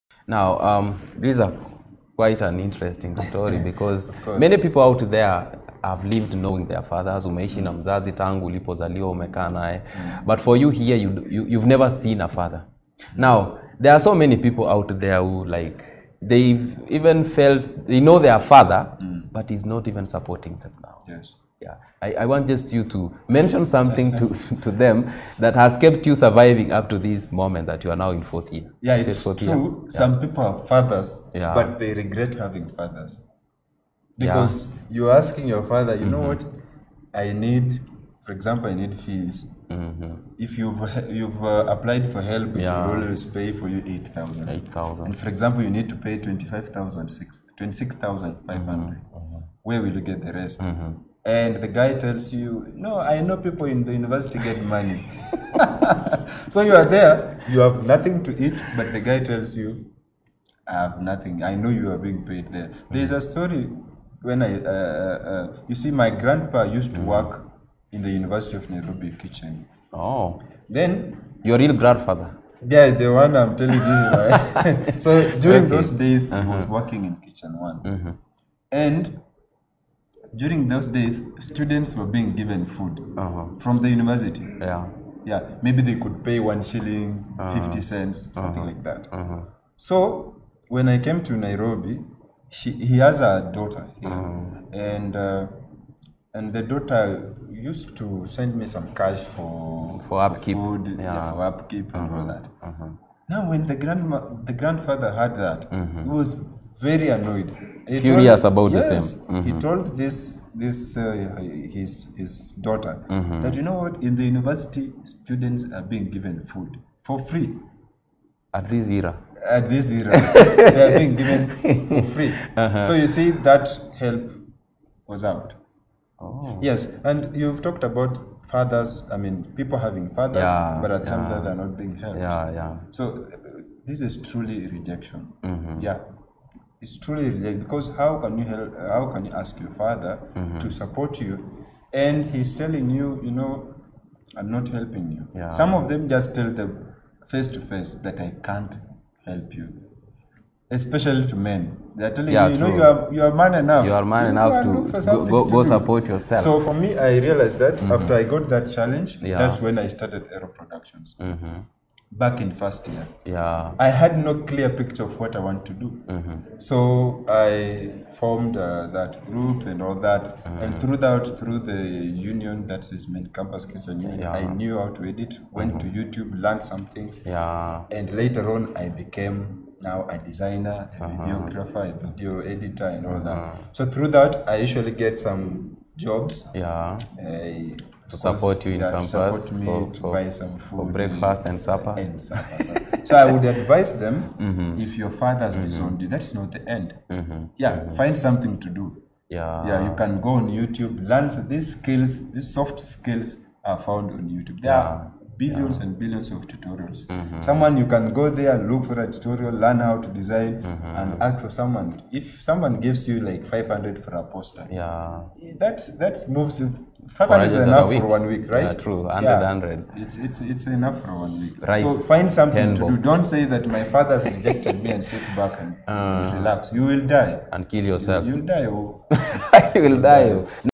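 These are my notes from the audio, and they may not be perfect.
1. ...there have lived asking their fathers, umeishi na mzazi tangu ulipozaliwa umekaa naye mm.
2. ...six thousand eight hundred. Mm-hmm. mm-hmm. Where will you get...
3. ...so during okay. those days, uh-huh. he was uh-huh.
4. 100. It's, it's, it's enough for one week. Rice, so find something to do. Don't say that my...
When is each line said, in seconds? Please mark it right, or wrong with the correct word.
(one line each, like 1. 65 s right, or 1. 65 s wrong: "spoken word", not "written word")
1. 5 s wrong: "knowing", not "asking"
2. 47 s wrong: "five", not "eight"
3. 75 s right
4. 219 s right.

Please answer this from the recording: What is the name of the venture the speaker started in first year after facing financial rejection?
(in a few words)
Ero productions.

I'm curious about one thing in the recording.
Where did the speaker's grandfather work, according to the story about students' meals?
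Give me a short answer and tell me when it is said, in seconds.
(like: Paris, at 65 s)
University of Nairobi kitchen, at 68 s.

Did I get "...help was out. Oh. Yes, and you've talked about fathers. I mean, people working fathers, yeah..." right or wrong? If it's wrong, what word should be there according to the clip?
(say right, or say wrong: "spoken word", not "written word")
wrong: "having", not "working".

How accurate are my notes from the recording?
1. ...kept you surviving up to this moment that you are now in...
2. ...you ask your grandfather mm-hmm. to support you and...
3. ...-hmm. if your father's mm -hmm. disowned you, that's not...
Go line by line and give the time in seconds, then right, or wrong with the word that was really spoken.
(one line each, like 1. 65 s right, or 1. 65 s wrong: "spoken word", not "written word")
1. 25 s right
2. 139 s wrong: "father", not "grandfather"
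3. 194 s right.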